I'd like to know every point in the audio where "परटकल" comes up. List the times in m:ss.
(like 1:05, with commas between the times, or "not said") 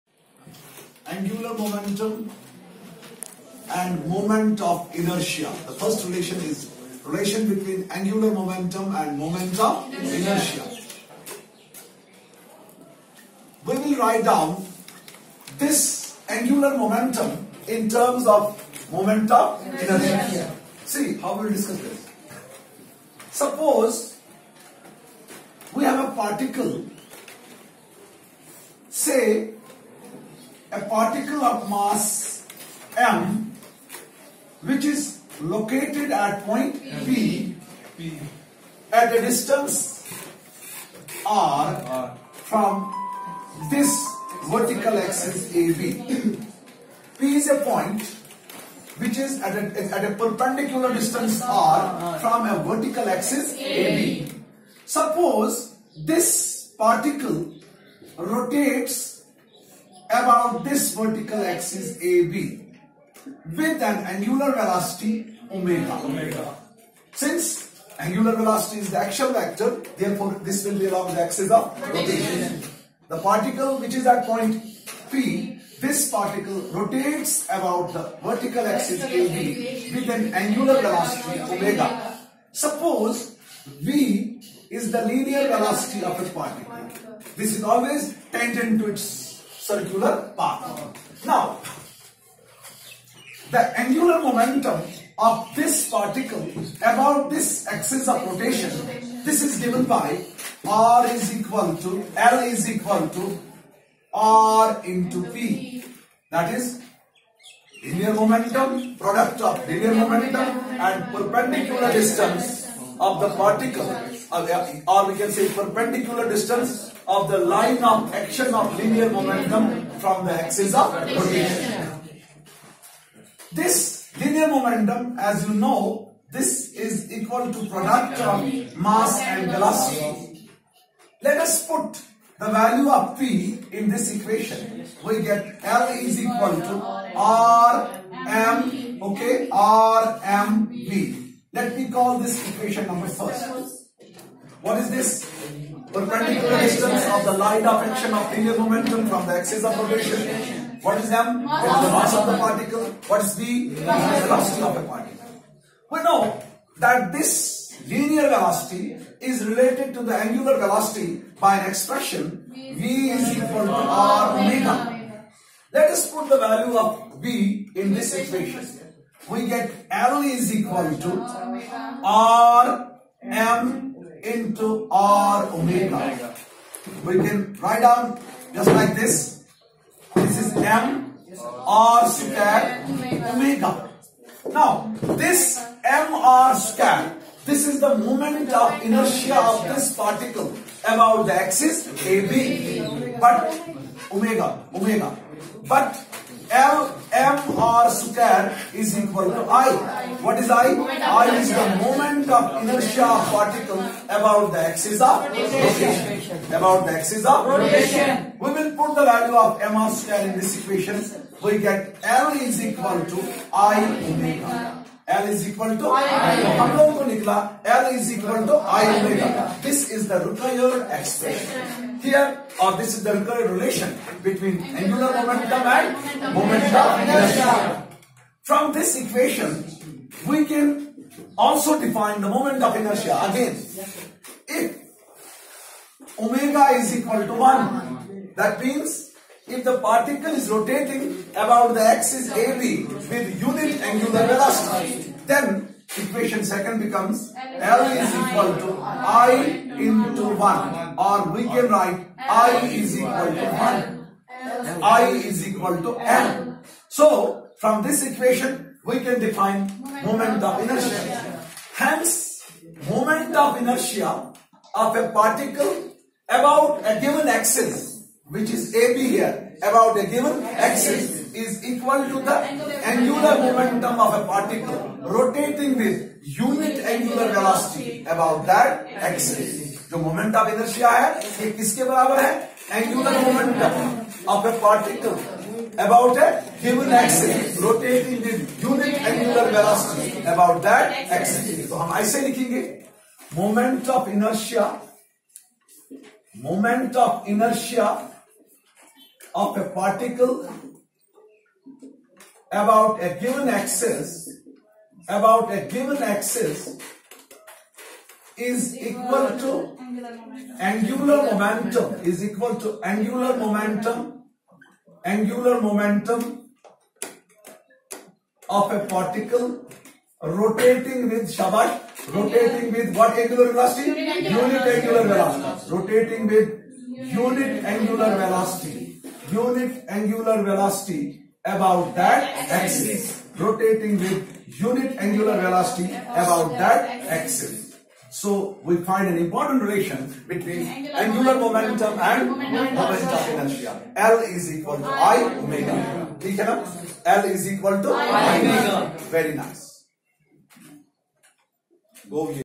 3:59, 4:44, 4:59.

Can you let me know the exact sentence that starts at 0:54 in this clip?
Suppose this particle rotates about this vertical axis AB with an angular velocity omega.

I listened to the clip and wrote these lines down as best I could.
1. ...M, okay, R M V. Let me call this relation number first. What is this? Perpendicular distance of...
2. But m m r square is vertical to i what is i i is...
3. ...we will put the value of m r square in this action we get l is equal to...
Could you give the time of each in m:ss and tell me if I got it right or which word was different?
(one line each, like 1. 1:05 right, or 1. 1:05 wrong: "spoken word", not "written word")
1. 2:18 wrong: "equation", not "relation"
2. 3:15 wrong: "equal", not "vertical"
3. 3:28 wrong: "equation", not "action".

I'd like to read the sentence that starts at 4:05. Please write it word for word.
Then equation second becomes L is equal to I into 1 or we can write I is equal to 1.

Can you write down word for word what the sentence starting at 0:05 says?
The first relation is relation between angular momentum and moment of inertia.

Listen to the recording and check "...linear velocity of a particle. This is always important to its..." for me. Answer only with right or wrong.
wrong.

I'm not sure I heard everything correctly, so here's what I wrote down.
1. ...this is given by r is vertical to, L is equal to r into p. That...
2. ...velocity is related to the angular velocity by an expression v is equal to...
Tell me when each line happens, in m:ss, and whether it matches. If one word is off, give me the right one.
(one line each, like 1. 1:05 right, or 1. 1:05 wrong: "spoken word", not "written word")
1. 1:39 wrong: "equal", not "vertical"
2. 2:38 right.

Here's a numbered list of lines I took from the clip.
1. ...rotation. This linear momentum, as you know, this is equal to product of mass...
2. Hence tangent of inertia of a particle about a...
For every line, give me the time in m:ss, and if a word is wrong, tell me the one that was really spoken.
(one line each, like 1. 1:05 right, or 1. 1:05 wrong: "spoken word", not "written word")
1. 2:00 right
2. 4:21 wrong: "moment", not "tangent".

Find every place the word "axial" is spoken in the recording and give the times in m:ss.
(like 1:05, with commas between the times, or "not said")
1:08.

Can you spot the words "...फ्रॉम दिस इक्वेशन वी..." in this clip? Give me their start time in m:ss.
3:48.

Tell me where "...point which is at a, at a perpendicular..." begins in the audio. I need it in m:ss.
0:47.